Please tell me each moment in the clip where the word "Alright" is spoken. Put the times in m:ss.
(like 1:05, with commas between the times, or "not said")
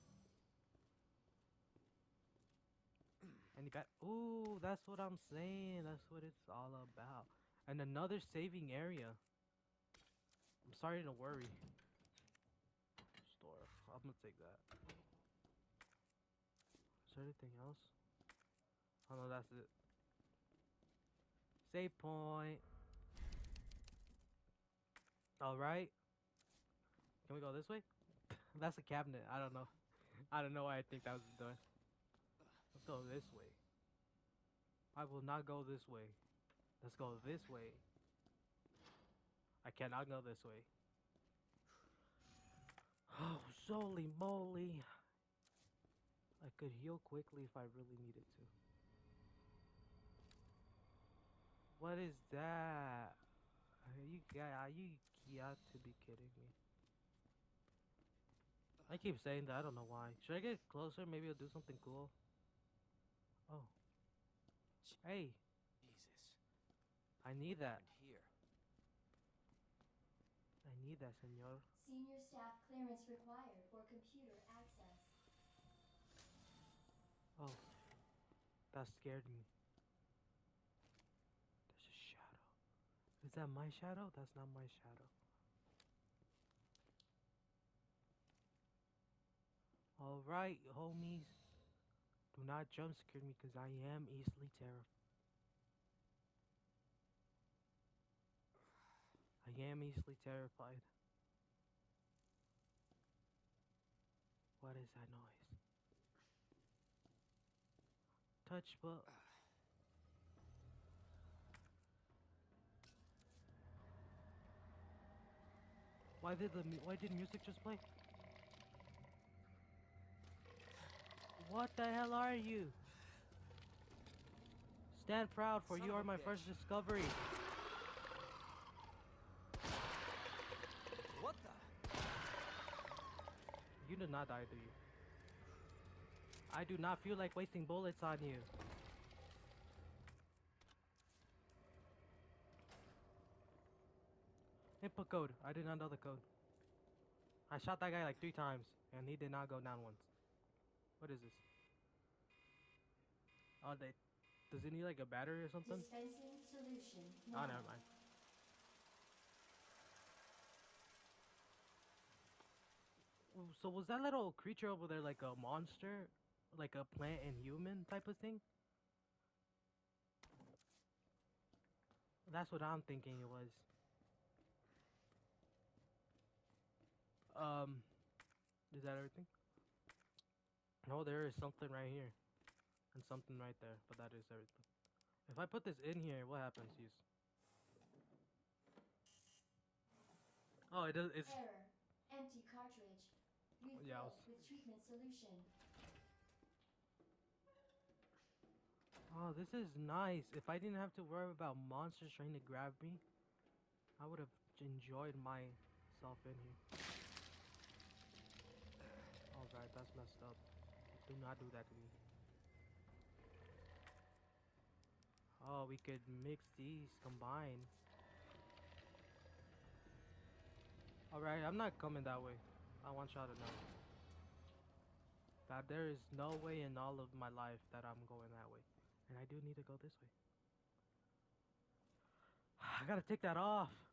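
0:25, 1:29, 3:29, 3:41.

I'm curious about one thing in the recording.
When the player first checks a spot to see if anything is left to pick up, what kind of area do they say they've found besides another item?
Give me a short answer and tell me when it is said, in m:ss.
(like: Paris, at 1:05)
saving area, at 0:08.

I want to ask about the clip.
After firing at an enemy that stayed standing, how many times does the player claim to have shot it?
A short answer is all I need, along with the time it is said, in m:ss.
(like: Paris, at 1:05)
3, at 2:28.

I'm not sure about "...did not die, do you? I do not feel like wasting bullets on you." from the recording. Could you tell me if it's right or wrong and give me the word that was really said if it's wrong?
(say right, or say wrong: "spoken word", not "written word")
right.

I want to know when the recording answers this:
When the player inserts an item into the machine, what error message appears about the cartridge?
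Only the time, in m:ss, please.
3:12.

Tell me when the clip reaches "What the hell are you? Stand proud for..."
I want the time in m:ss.
2:01.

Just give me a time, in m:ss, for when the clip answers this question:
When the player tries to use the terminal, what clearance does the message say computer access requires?
1:11.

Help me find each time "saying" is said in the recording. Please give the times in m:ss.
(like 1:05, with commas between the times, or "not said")
0:05, 0:59.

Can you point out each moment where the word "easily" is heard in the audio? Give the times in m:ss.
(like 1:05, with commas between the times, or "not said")
1:34, 1:39.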